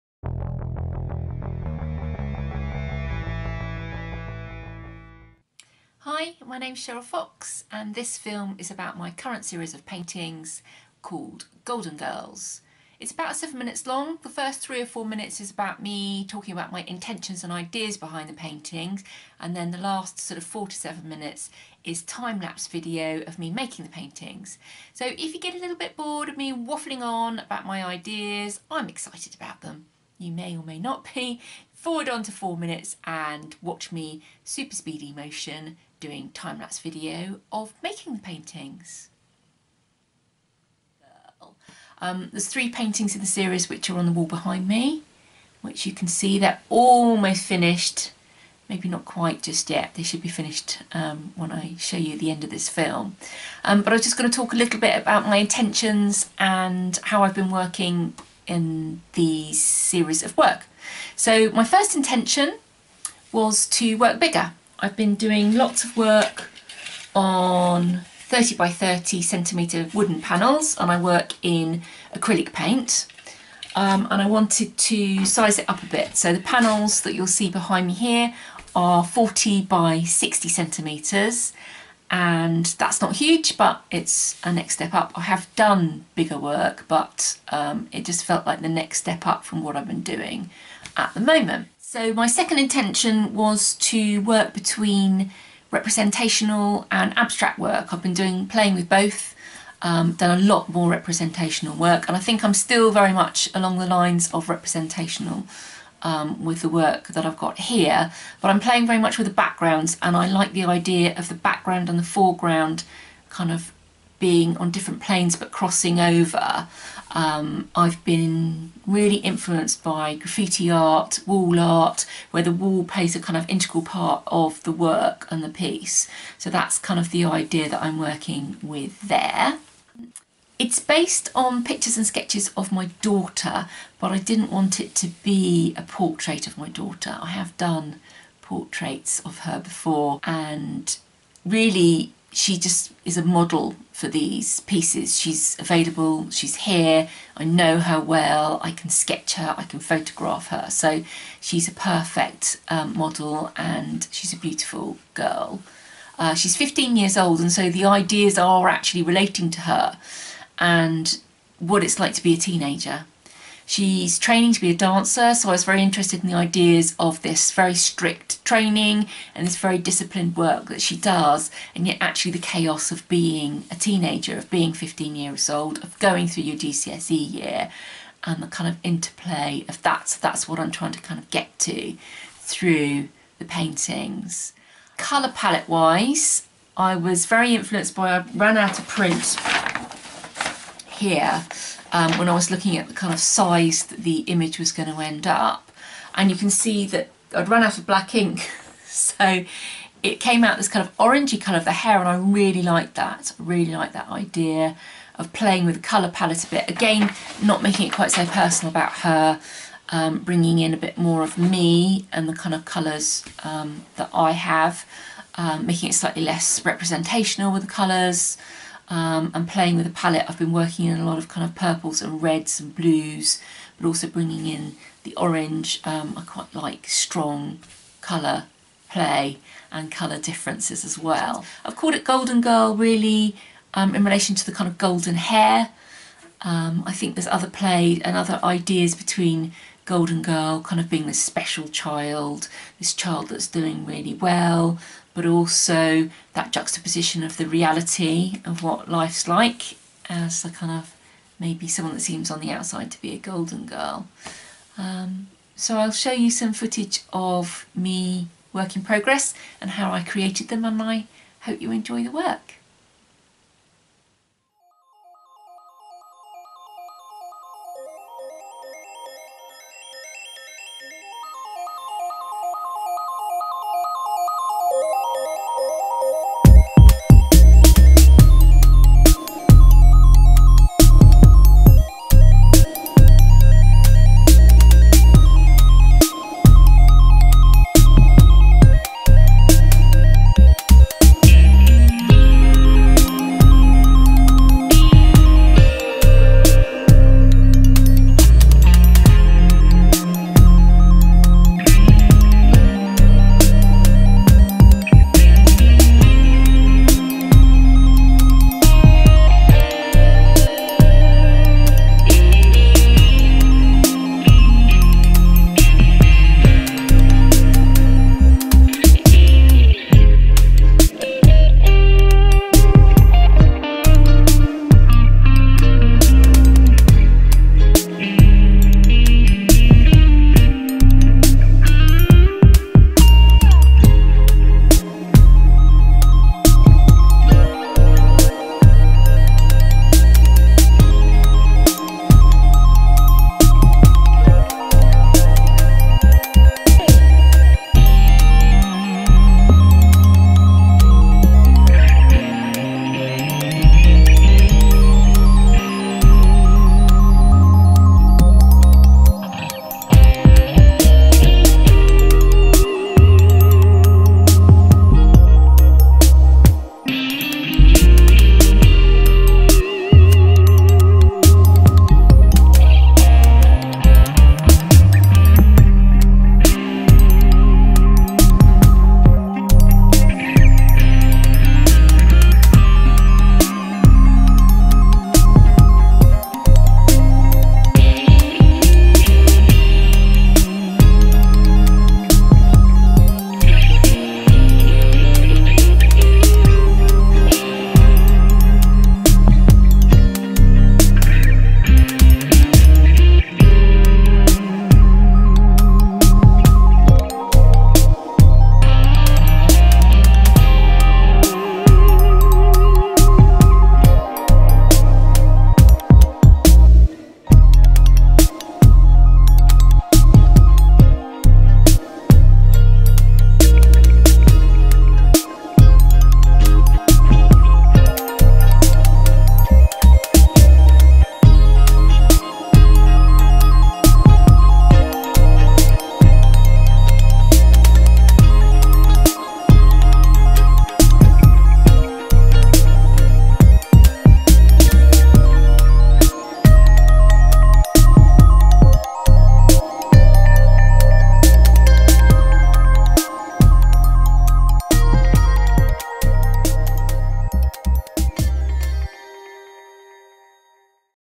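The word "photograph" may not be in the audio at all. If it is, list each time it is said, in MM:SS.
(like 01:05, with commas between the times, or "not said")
02:29.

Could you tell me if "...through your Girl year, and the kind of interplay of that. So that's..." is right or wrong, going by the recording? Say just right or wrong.
wrong.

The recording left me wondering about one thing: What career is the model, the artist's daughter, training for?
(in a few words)
Dancer.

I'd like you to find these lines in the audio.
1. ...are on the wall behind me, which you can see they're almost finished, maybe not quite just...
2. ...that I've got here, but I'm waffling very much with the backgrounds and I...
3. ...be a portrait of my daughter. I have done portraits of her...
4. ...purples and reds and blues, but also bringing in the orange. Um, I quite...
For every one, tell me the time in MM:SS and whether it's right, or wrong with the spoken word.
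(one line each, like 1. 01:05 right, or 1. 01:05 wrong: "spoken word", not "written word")
1. 00:43 right
2. 01:47 wrong: "playing", not "waffling"
3. 02:15 right
4. 03:41 right.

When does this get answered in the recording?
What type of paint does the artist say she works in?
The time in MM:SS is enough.
01:12.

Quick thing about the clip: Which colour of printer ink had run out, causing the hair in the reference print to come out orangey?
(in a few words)
Black.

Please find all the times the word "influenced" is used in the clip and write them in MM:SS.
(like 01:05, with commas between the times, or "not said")
01:59, 03:07.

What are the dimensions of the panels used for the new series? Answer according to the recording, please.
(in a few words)
40 by 60 centimetres.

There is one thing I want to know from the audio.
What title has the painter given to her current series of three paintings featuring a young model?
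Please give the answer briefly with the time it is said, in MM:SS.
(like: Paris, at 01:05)
Golden Girls, at 00:11.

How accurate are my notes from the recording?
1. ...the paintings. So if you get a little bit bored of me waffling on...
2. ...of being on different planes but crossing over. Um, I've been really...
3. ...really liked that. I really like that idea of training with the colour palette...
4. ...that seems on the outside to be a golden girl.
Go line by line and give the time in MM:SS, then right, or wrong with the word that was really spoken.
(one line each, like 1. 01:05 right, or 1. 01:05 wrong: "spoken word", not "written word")
1. 00:23 right
2. 01:53 right
3. 03:22 wrong: "playing", not "training"
4. 04:11 right.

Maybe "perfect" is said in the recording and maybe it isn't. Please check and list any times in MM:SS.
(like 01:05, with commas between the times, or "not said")
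02:31.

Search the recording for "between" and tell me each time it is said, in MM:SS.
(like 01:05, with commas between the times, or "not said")
01:34, 03:58.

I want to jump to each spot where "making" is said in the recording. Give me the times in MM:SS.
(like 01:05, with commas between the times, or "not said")
00:23, 00:37, 03:27, 03:35.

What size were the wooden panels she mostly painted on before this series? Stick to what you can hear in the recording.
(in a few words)
30 by 30 centimetres.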